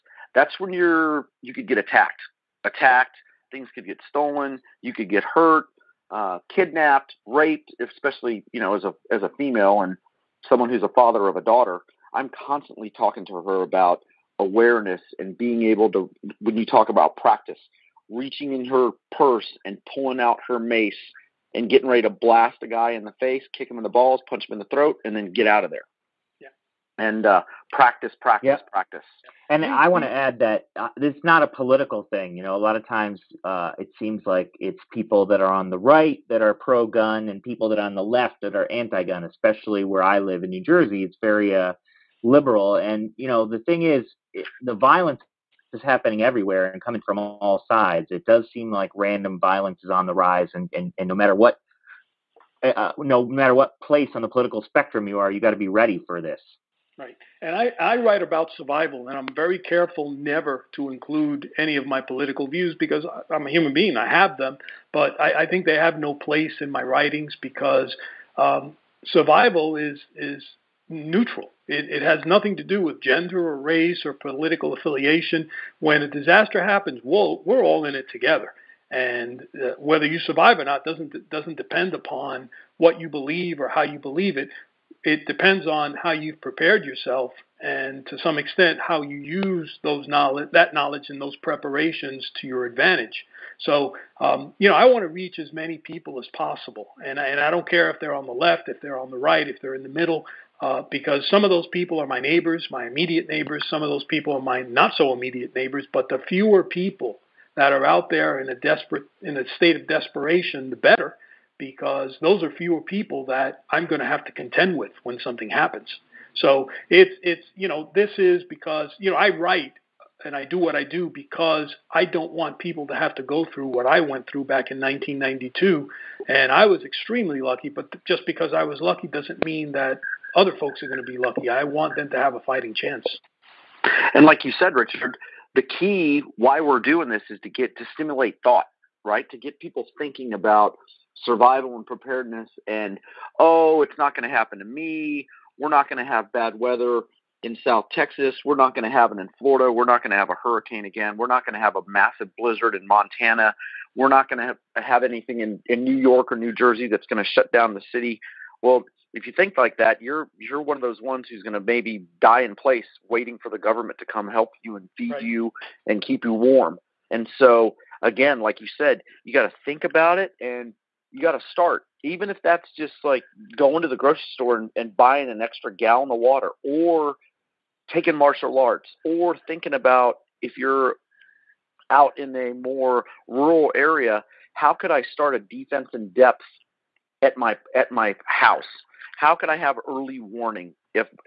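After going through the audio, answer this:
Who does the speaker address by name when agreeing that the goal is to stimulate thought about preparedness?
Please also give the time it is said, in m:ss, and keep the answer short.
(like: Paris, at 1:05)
Richard, at 2:14.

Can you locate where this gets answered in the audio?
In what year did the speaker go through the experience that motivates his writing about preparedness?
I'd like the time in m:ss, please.
2:04.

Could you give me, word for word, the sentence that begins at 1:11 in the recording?
It, it, has nothing to do with gender or race or political affiliation.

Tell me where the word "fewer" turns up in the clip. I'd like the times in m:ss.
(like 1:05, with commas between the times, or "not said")
1:46, 1:52.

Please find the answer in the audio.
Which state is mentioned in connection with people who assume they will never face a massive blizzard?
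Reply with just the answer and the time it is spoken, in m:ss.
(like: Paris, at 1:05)
Montana, at 2:32.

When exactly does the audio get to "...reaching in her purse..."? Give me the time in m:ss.
0:18.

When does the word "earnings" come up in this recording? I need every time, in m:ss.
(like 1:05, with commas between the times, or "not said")
not said.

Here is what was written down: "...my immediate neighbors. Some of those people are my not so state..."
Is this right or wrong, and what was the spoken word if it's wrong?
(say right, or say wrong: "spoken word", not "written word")
wrong: "immediate", not "state".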